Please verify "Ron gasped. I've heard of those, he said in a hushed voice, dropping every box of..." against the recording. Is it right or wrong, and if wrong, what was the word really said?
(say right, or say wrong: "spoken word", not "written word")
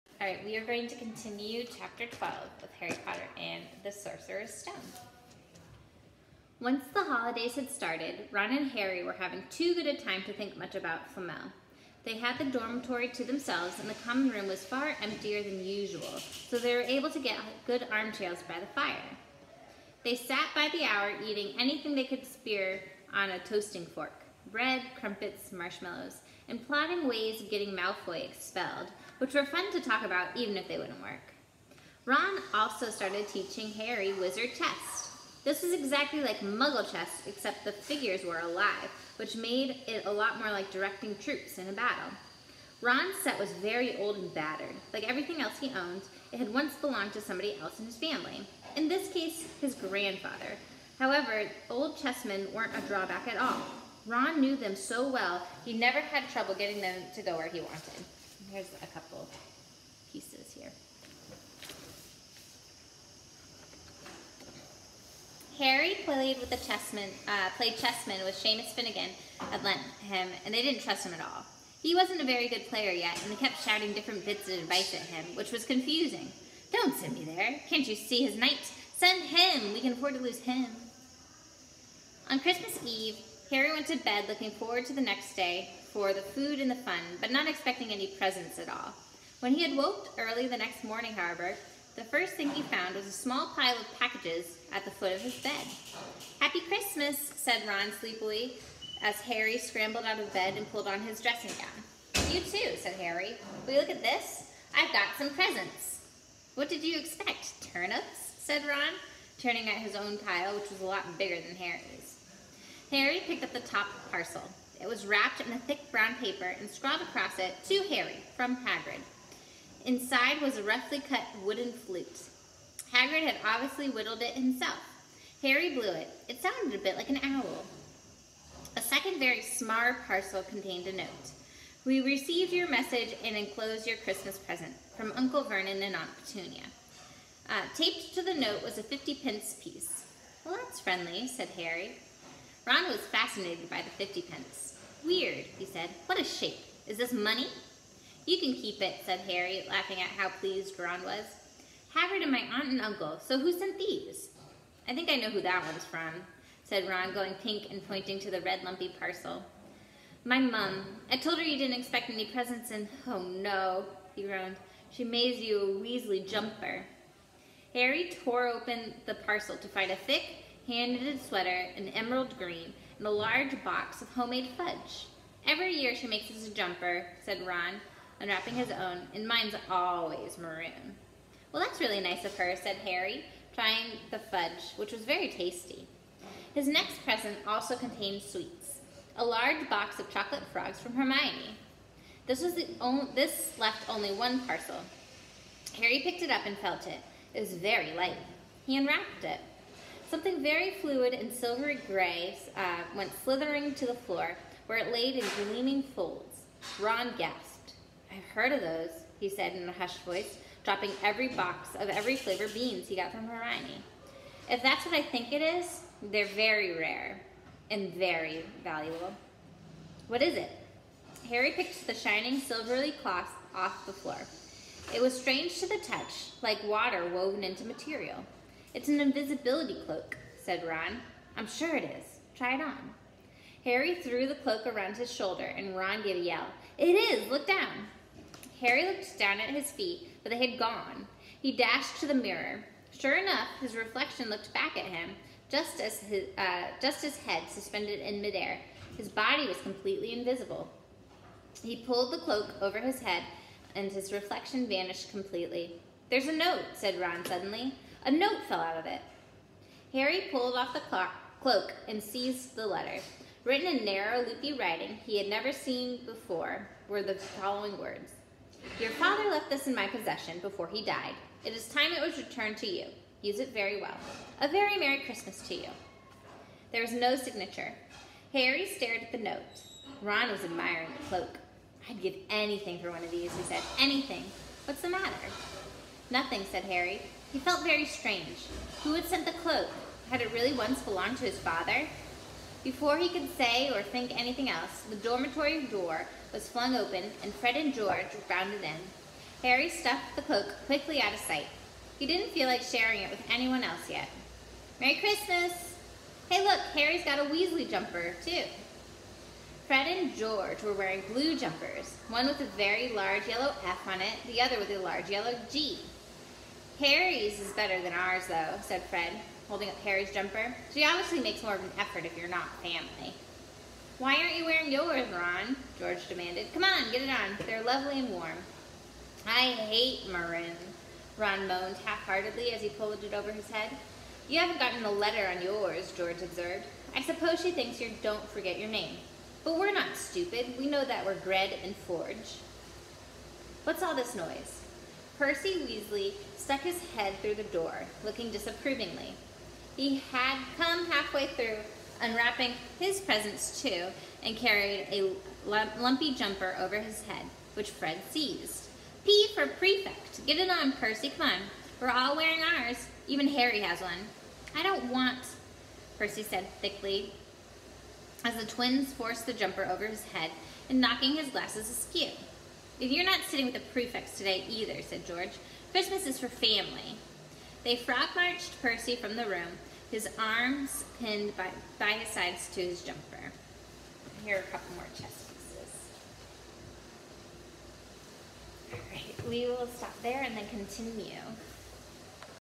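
right.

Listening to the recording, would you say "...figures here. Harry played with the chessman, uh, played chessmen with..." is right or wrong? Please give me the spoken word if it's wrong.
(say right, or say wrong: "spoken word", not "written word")
wrong: "pieces", not "figures".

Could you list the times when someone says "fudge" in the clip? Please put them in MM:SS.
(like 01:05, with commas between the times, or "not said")
02:54, 03:04.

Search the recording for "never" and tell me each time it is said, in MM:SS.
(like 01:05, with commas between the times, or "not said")
00:55, 04:25.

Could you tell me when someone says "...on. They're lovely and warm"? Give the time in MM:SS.
05:27.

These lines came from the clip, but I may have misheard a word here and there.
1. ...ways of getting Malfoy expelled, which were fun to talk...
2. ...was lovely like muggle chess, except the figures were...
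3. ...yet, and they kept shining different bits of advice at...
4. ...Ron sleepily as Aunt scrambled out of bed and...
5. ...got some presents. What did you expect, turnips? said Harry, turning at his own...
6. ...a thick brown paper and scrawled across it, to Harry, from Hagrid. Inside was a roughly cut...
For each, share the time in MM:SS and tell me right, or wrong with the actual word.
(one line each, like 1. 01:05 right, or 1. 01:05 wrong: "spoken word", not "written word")
1. 00:27 right
2. 00:35 wrong: "exactly", not "lovely"
3. 01:12 wrong: "shouting", not "shining"
4. 01:37 wrong: "Harry", not "Aunt"
5. 01:44 wrong: "Ron", not "Harry"
6. 01:55 right.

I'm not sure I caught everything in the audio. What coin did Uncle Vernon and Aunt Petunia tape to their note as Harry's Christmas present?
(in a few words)
50 pence piece.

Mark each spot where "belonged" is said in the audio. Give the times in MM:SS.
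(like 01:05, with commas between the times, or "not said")
00:46, 04:50.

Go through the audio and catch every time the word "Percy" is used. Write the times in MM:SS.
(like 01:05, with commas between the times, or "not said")
05:45, 06:00, 06:05, 06:18.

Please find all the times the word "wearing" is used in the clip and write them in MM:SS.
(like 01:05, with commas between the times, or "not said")
05:10, 05:24, 06:02.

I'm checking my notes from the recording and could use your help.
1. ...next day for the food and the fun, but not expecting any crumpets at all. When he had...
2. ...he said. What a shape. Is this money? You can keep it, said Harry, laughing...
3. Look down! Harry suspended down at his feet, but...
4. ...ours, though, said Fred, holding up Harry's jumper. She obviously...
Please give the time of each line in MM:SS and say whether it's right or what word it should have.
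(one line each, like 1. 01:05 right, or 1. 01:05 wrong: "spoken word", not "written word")
1. 01:25 wrong: "presents", not "crumpets"
2. 02:25 right
3. 03:57 wrong: "looked", not "suspended"
4. 05:17 right.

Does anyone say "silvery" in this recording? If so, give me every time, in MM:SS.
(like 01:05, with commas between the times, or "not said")
03:21, 03:42.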